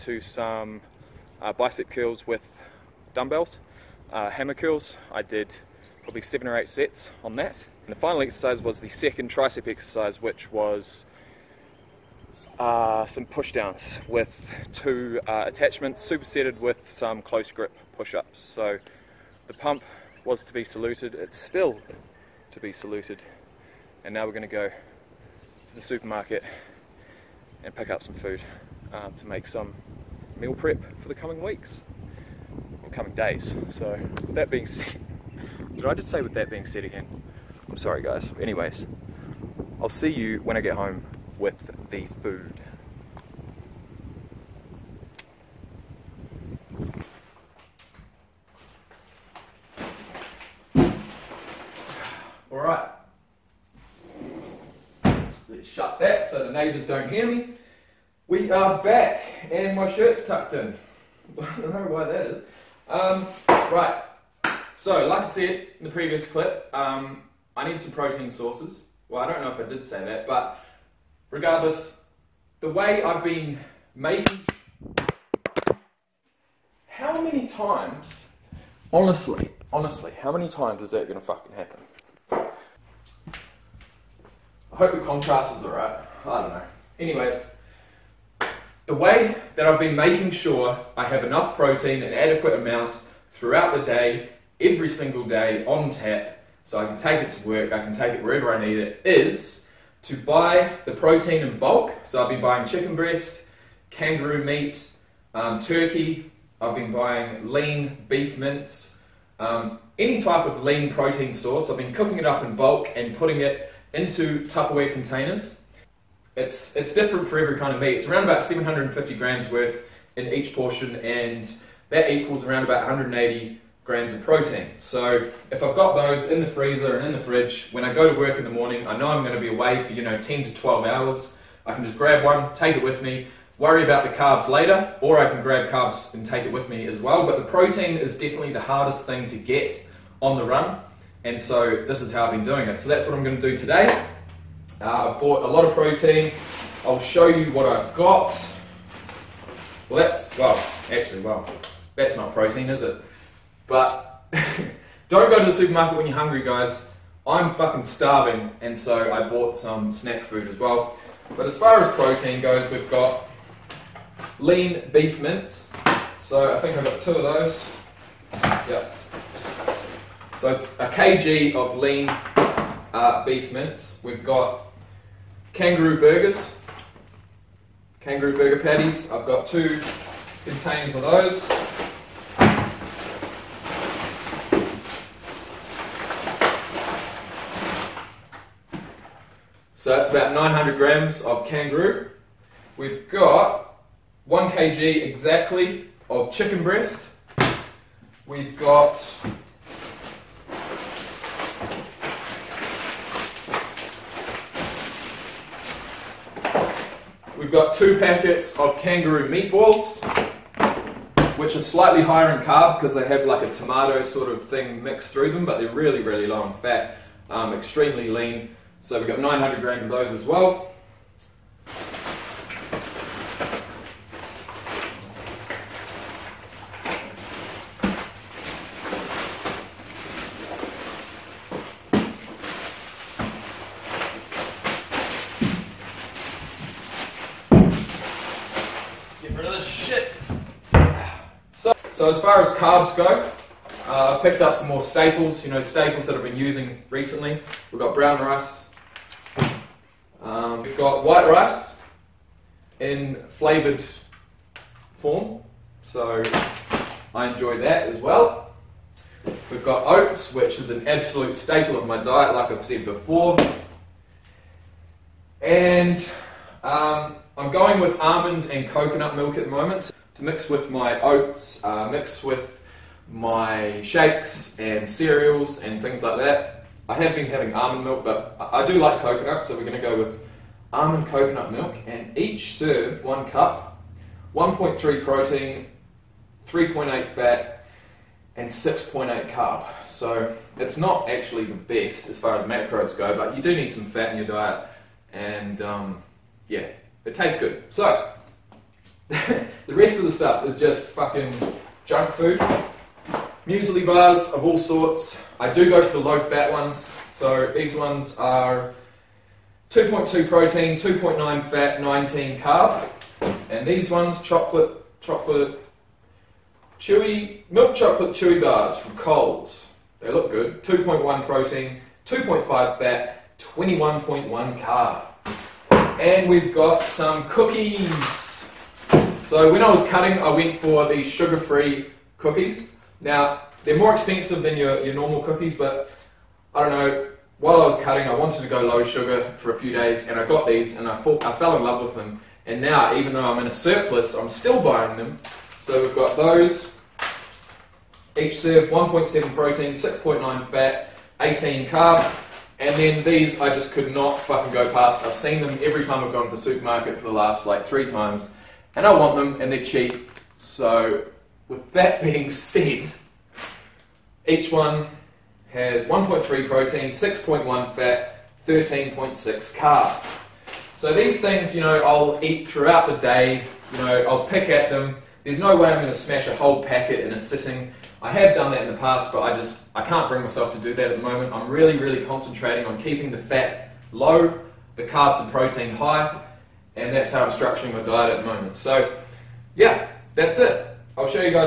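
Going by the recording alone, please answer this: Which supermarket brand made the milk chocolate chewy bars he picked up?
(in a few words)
Coles.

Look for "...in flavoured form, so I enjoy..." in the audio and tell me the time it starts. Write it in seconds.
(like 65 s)
252 s.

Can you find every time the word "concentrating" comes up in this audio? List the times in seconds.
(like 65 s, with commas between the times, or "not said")
382 s.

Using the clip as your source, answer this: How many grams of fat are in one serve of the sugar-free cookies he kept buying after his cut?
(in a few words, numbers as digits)
6.9.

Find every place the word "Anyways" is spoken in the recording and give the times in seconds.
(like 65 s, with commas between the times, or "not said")
38 s, 86 s.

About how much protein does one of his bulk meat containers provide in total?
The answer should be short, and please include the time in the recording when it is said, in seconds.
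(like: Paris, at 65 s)
180 grams, at 122 s.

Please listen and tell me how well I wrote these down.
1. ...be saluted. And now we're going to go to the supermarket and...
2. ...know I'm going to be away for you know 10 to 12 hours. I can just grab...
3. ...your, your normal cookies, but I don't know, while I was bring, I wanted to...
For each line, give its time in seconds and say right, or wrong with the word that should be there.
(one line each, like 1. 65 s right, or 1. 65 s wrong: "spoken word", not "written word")
1. 22 s right
2. 128 s right
3. 334 s wrong: "cutting", not "bring".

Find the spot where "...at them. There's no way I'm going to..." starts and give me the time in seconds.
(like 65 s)
374 s.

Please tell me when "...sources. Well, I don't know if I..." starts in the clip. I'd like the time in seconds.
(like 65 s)
68 s.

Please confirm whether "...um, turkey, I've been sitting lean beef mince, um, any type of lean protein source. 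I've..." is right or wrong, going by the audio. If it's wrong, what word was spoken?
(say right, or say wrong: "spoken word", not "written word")
wrong: "buying", not "sitting".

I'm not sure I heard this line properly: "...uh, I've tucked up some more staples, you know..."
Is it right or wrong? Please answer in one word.
wrong.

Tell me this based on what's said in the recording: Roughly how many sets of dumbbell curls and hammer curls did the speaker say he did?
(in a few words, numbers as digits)
7 or 8.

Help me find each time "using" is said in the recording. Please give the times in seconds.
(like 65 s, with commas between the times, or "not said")
246 s.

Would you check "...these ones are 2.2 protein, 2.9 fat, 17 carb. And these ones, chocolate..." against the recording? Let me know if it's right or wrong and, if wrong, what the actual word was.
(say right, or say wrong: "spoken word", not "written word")
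wrong: "19", not "17".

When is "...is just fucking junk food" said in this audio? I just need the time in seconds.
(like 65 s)
300 s.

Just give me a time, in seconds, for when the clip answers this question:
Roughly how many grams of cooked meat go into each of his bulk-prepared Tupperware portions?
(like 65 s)
118 s.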